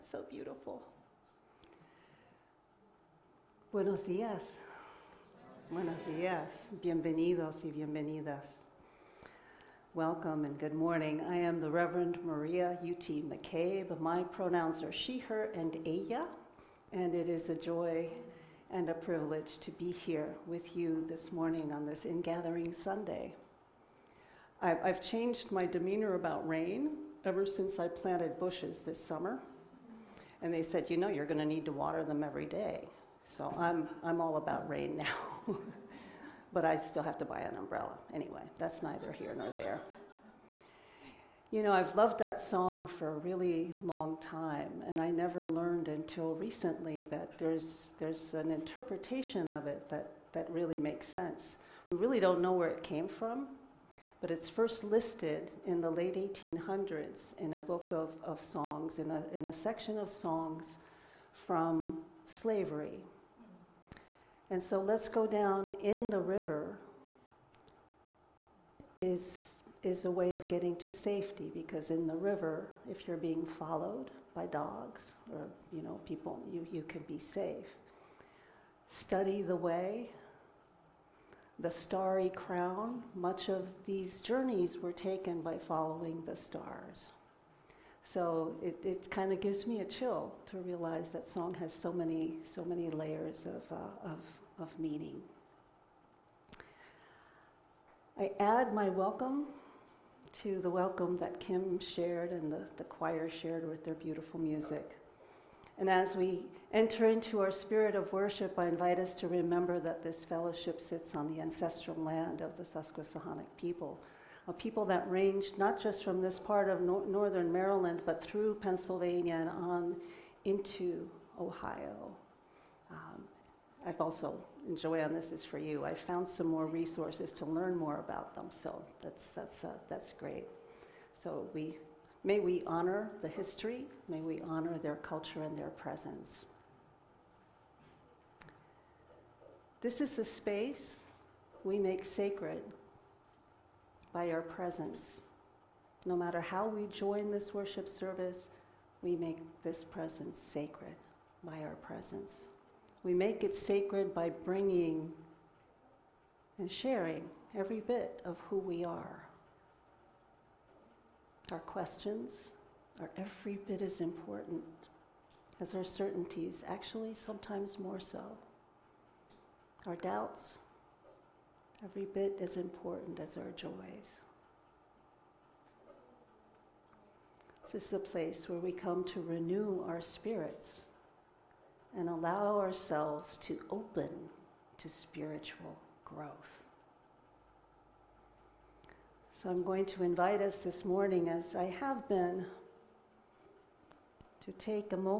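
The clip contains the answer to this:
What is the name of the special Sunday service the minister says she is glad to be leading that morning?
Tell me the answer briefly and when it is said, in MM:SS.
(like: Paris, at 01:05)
Ingathering Sunday, at 00:22.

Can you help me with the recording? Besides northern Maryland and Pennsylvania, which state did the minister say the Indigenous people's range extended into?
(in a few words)
Ohio.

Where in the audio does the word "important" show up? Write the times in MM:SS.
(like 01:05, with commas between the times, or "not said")
02:44, 02:52.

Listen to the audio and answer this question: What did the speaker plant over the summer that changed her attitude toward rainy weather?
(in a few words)
Bushes.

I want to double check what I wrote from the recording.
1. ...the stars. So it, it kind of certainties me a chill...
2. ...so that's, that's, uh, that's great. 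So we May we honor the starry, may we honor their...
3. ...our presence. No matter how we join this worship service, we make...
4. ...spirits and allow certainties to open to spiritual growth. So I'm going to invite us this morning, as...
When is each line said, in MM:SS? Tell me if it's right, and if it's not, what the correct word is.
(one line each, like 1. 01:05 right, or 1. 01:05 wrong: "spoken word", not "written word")
1. 01:26 wrong: "gives", not "certainties"
2. 02:08 wrong: "history", not "starry"
3. 02:24 right
4. 03:00 wrong: "ourselves", not "certainties".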